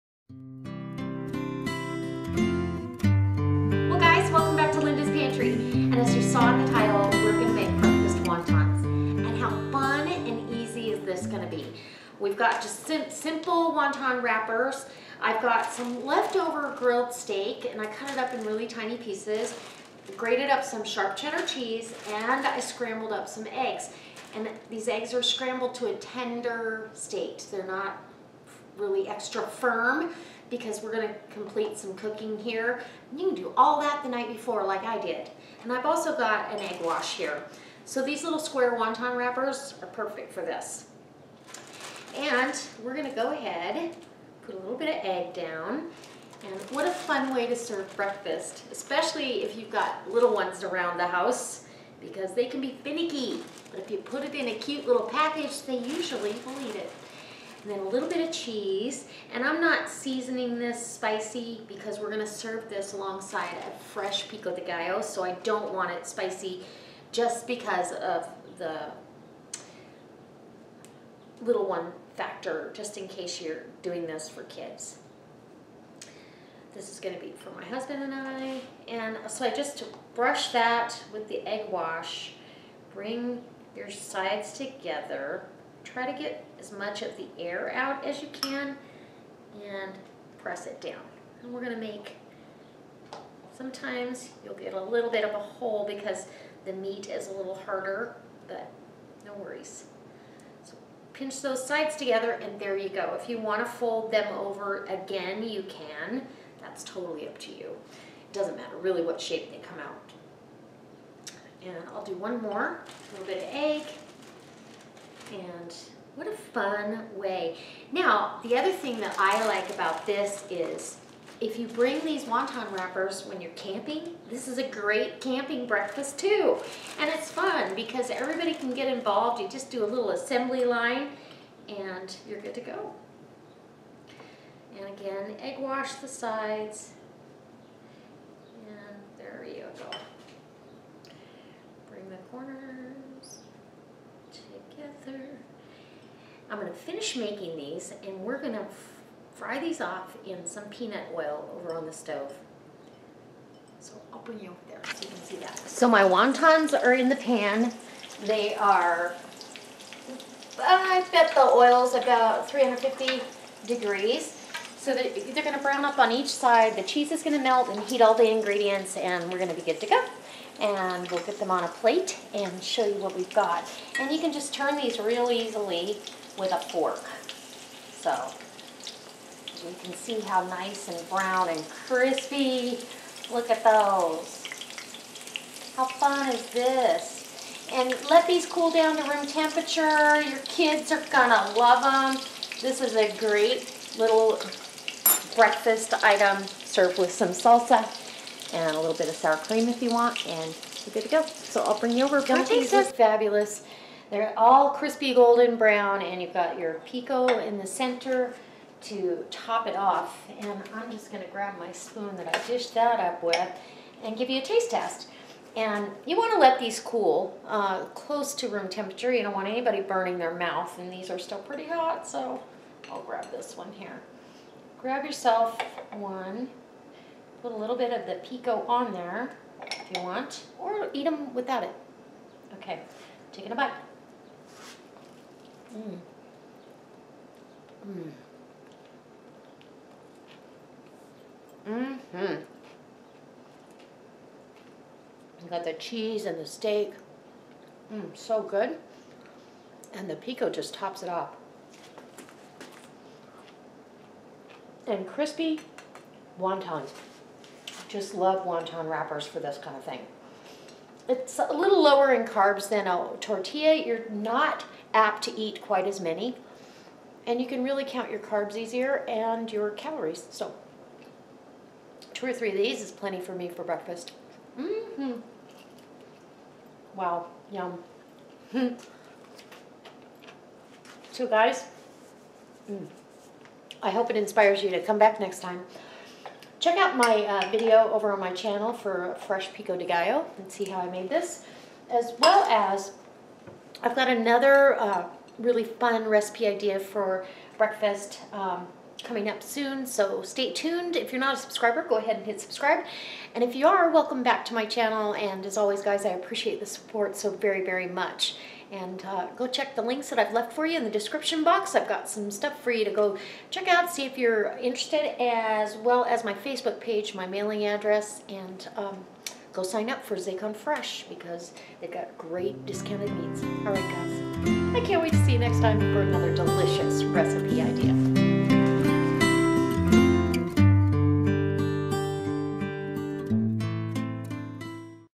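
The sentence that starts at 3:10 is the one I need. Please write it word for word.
Your kids are gonna love them.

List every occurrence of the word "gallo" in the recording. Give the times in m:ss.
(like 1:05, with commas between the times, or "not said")
1:04, 4:49.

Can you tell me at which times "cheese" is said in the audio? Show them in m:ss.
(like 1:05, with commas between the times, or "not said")
0:21, 0:58, 2:46, 4:05.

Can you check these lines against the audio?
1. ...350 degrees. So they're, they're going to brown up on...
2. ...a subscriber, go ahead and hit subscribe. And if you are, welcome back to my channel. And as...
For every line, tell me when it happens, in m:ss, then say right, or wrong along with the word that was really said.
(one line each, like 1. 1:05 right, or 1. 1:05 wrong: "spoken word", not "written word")
1. 2:42 right
2. 5:01 right.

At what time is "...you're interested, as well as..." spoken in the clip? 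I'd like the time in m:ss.
5:14.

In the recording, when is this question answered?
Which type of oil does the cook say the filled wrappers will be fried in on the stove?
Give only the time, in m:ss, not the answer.
2:30.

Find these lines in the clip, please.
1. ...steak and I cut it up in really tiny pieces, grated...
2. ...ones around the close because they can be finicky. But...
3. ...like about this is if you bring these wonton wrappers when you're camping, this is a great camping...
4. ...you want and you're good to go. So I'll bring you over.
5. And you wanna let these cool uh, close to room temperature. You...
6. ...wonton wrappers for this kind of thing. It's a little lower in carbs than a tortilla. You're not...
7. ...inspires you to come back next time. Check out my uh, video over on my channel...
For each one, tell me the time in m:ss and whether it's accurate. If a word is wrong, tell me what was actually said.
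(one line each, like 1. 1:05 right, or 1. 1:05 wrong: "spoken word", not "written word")
1. 0:17 right
2. 0:50 wrong: "house", not "close"
3. 1:59 right
4. 3:19 right
5. 3:35 right
6. 4:18 right
7. 4:44 right.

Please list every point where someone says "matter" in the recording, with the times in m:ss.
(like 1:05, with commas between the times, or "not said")
1:48.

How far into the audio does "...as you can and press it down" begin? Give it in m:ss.
1:28.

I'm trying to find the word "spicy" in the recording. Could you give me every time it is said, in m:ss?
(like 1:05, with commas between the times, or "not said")
1:00, 1:06.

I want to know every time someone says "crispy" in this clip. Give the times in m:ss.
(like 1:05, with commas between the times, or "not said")
3:01, 3:24, 4:15.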